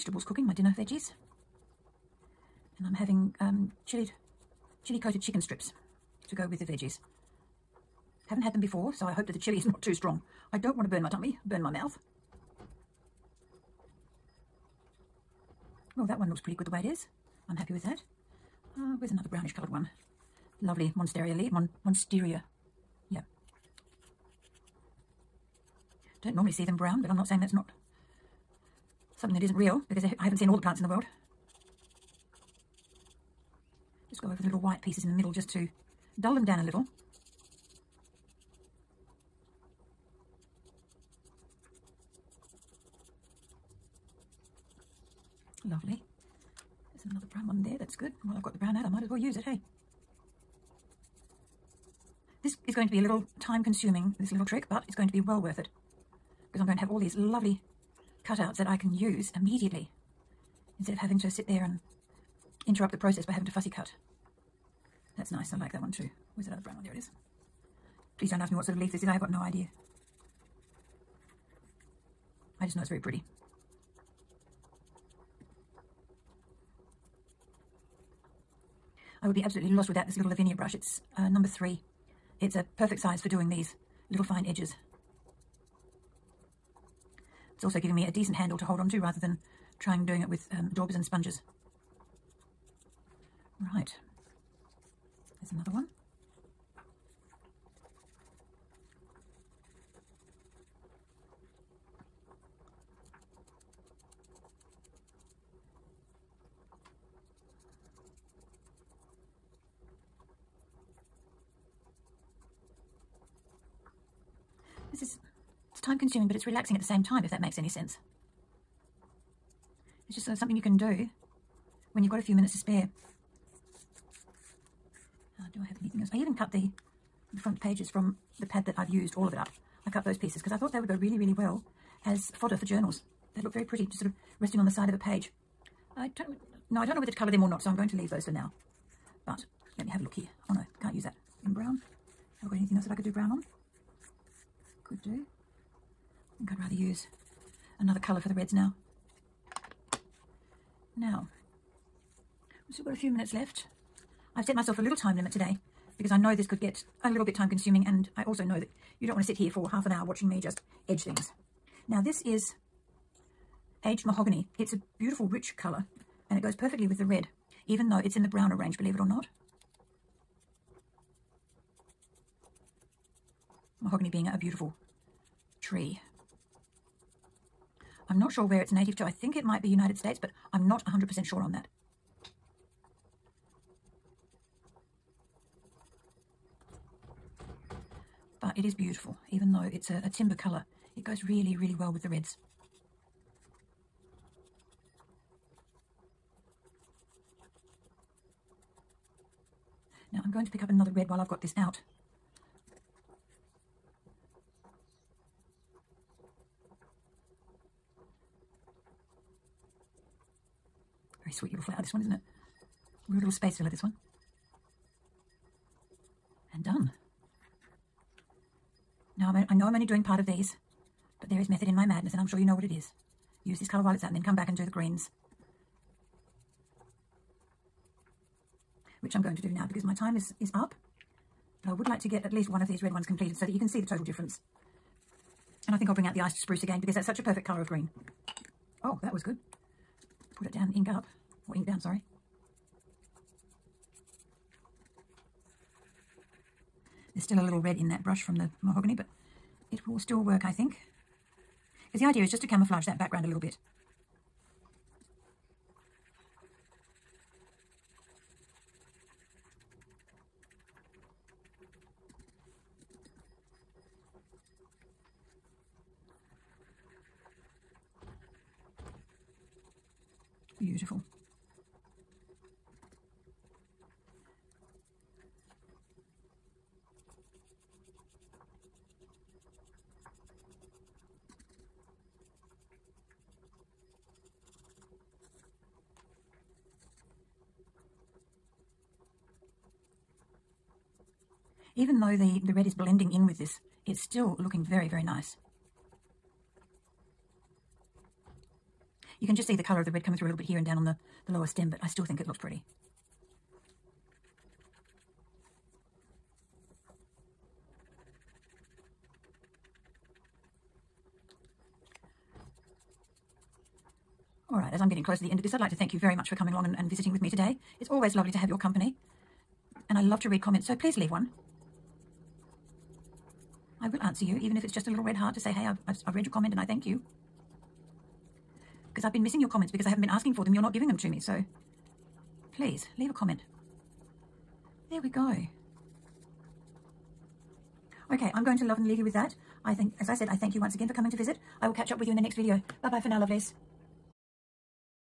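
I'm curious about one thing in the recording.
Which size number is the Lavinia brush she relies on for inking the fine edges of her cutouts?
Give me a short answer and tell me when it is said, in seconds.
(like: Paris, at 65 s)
3, at 81 s.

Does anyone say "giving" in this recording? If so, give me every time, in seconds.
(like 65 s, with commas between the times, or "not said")
87 s, 330 s.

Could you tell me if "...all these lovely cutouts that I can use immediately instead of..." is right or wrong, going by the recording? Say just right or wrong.
right.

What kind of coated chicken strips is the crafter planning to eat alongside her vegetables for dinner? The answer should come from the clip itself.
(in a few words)
Chili coated.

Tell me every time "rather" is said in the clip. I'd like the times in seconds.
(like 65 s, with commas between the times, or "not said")
88 s, 146 s.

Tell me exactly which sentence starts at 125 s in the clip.
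Uh, do I have anything else?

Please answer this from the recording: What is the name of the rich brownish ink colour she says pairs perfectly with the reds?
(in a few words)
Aged mahogany.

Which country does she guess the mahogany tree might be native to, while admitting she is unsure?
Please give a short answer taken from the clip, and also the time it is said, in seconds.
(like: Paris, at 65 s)
United States, at 179 s.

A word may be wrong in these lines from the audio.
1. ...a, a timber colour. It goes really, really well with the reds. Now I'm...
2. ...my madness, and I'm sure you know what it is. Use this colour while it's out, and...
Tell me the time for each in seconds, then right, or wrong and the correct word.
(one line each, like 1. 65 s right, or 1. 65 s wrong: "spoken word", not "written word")
1. 189 s right
2. 221 s right.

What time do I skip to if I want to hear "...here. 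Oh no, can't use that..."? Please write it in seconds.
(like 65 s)
140 s.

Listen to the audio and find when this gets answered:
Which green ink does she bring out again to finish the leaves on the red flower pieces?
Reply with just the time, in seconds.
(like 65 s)
236 s.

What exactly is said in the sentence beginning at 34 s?
Just go over the little white pieces in the middle just to dull them down a little.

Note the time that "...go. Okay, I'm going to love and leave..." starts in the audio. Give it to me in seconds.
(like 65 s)
335 s.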